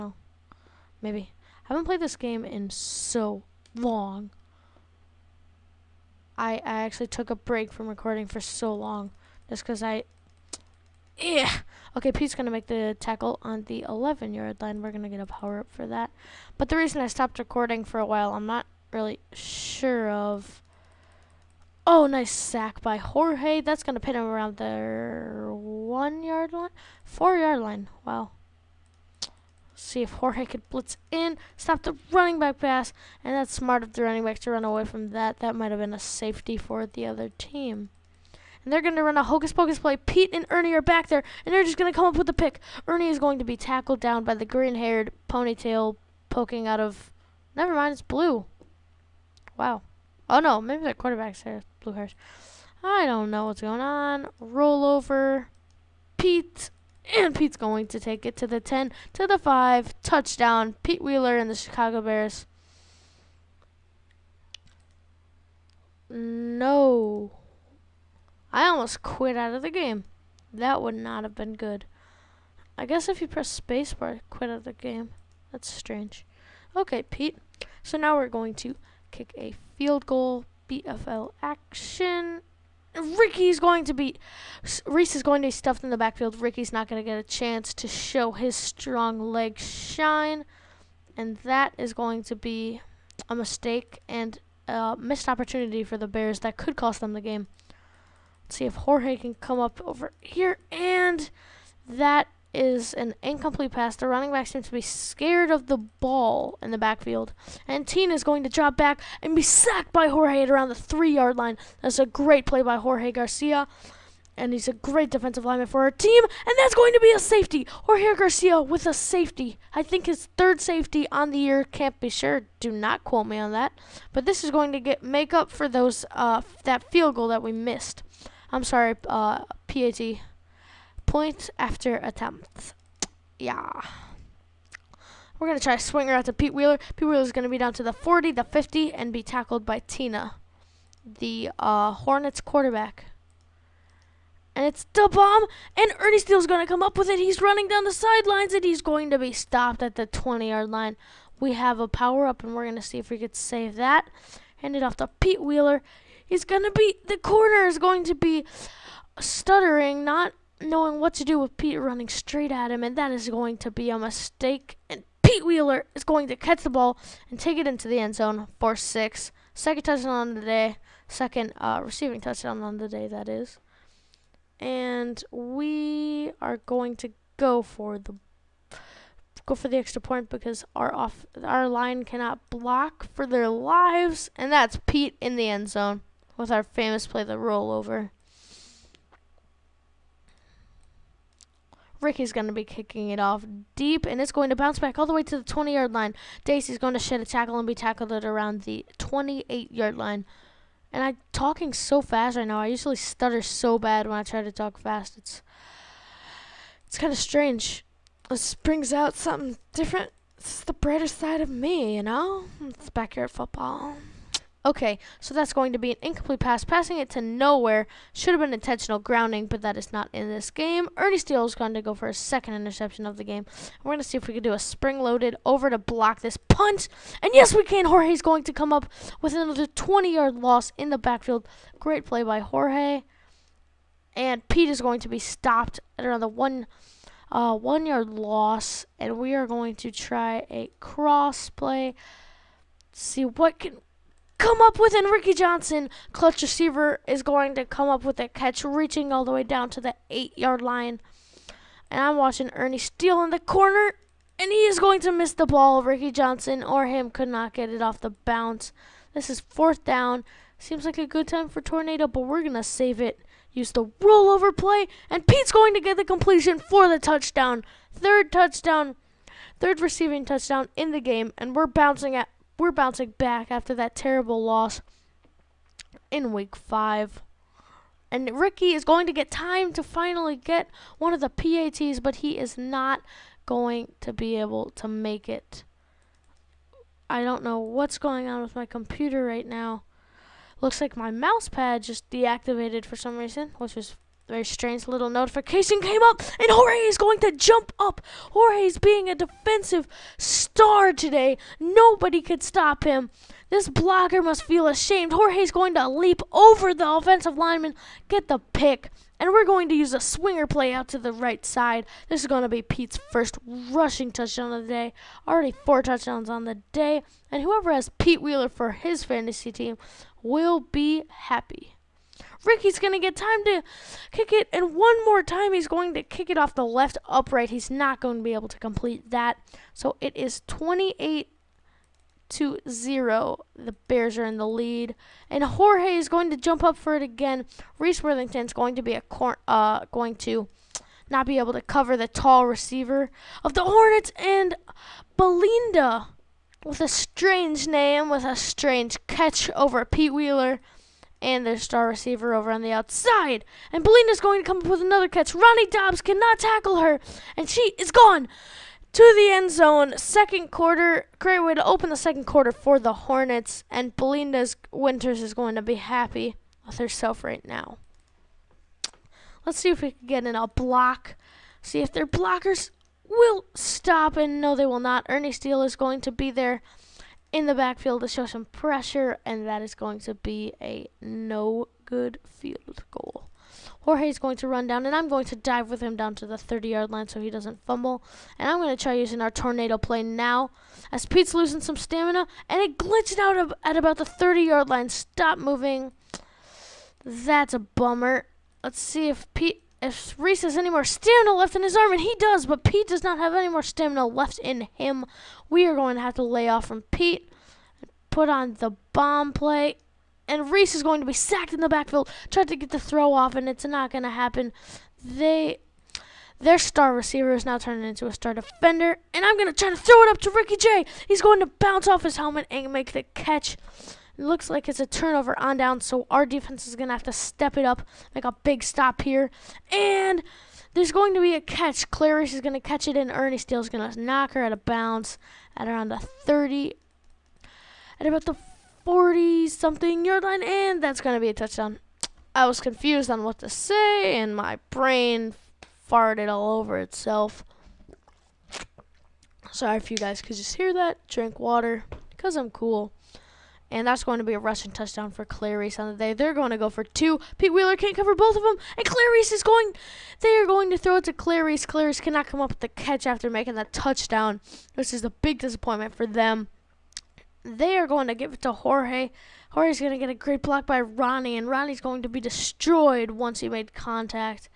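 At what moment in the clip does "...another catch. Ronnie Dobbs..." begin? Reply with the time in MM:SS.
05:54.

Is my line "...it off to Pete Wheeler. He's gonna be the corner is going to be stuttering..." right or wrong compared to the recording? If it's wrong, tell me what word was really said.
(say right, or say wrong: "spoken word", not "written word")
right.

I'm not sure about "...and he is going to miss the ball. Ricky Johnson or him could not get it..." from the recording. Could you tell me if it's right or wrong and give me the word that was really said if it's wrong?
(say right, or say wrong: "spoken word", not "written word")
right.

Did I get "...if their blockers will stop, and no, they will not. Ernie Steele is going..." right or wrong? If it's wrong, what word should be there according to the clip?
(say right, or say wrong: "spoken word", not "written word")
right.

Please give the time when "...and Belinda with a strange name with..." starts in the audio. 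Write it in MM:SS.
05:44.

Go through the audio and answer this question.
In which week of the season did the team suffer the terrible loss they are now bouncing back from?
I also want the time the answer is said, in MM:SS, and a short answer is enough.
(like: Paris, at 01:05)
week five, at 04:36.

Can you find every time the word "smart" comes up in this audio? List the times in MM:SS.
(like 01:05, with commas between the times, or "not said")
00:33.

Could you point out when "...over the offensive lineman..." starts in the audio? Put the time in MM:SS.
05:06.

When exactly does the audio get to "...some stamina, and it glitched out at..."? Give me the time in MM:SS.
06:31.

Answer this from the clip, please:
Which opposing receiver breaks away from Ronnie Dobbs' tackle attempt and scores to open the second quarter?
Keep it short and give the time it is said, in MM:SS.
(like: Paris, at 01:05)
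Belinda Winters, at 06:03.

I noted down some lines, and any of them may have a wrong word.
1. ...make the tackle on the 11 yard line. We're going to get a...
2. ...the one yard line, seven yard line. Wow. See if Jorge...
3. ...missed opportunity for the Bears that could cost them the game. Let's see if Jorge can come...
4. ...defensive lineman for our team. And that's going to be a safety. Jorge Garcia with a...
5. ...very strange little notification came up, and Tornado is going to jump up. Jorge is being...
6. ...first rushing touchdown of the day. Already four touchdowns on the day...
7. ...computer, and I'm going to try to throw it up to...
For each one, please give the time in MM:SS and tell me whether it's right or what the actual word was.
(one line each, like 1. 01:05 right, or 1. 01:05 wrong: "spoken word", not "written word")
1. 00:12 right
2. 00:24 wrong: "four", not "seven"
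3. 01:34 right
4. 01:55 right
5. 04:54 wrong: "Jorge", not "Tornado"
6. 05:13 right
7. 06:58 wrong: "defender", not "computer".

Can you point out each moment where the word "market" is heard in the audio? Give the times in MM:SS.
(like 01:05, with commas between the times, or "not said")
not said.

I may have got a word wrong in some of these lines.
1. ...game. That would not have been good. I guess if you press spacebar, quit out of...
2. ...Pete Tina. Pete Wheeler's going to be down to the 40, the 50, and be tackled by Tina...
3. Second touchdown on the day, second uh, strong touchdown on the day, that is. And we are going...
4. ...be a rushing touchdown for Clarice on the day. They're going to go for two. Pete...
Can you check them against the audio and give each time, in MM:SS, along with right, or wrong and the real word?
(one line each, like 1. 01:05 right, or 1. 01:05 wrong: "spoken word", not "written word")
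1. 01:09 right
2. 02:16 wrong: "Wheeler", not "Tina"
3. 02:49 wrong: "receiving", not "strong"
4. 07:34 right.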